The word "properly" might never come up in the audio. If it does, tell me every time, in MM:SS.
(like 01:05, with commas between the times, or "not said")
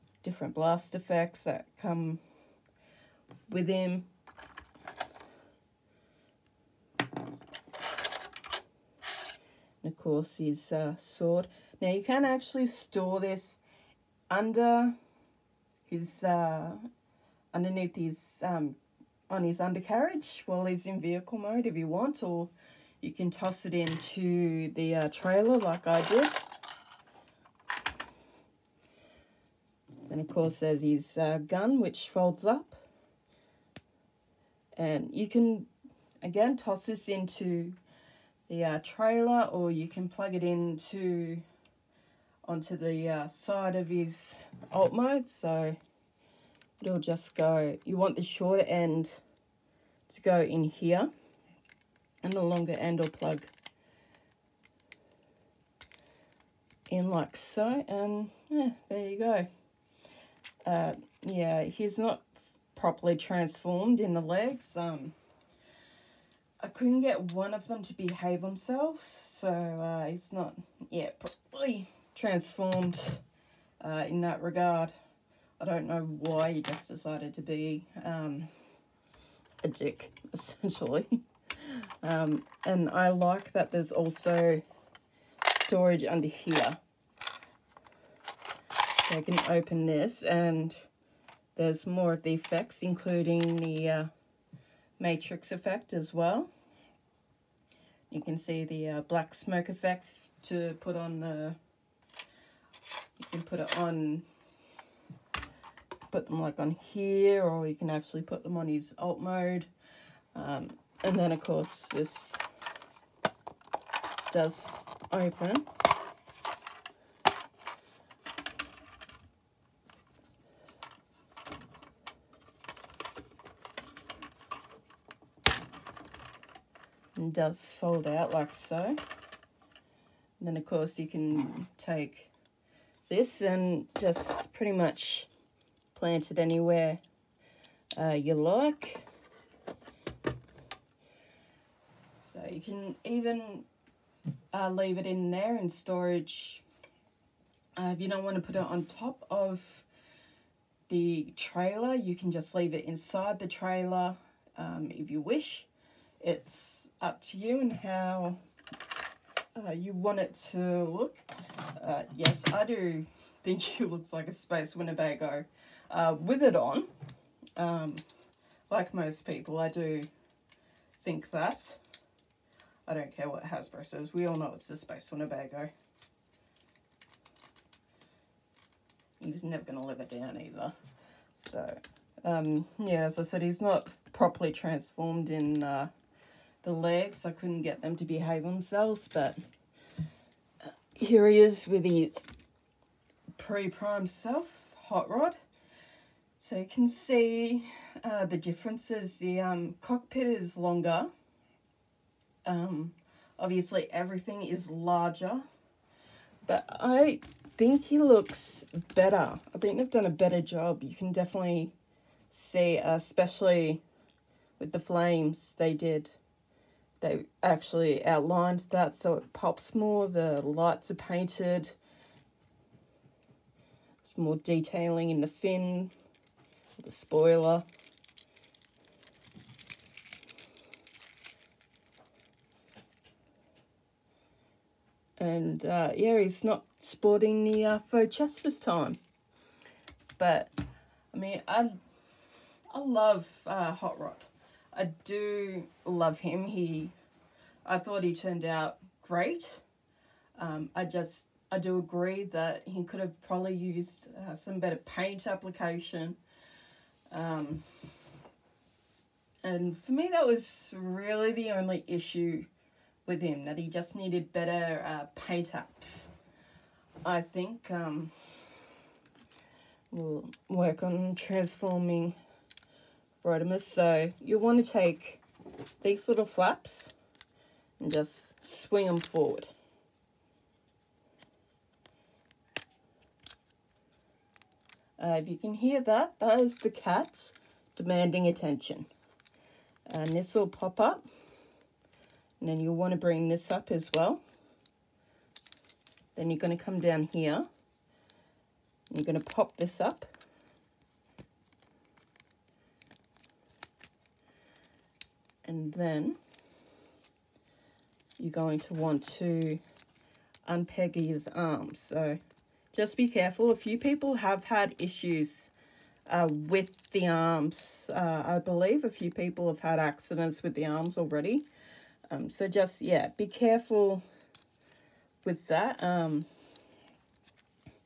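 01:02, 01:11, 03:04.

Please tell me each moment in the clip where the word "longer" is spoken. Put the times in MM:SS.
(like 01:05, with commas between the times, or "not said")
00:52, 03:20.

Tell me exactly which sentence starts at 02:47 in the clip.
Um, like most people, I do think that.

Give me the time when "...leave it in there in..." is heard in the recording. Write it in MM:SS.
02:24.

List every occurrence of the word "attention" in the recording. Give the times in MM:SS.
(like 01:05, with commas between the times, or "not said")
04:48.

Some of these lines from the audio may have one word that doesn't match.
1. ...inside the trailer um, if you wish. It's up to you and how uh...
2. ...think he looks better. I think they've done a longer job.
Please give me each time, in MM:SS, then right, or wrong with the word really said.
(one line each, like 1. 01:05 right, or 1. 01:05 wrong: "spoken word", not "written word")
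1. 02:32 right
2. 03:27 wrong: "better", not "longer".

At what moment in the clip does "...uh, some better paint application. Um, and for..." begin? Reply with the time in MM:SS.
04:14.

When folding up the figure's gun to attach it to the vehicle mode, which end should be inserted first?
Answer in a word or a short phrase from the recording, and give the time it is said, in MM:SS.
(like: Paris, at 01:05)
The shorter end, at 00:48.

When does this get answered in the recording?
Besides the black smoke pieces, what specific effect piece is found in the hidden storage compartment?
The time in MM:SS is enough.
01:34.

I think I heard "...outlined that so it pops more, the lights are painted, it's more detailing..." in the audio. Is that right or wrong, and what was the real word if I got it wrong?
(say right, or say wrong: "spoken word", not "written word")
right.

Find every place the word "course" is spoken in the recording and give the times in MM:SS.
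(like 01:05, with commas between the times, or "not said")
00:09, 00:30, 01:51, 02:10.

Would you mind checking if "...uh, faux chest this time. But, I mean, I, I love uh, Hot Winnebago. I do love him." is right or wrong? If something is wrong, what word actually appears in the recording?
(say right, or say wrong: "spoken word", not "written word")
wrong: "Rod", not "Winnebago".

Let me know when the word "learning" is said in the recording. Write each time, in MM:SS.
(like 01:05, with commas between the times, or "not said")
not said.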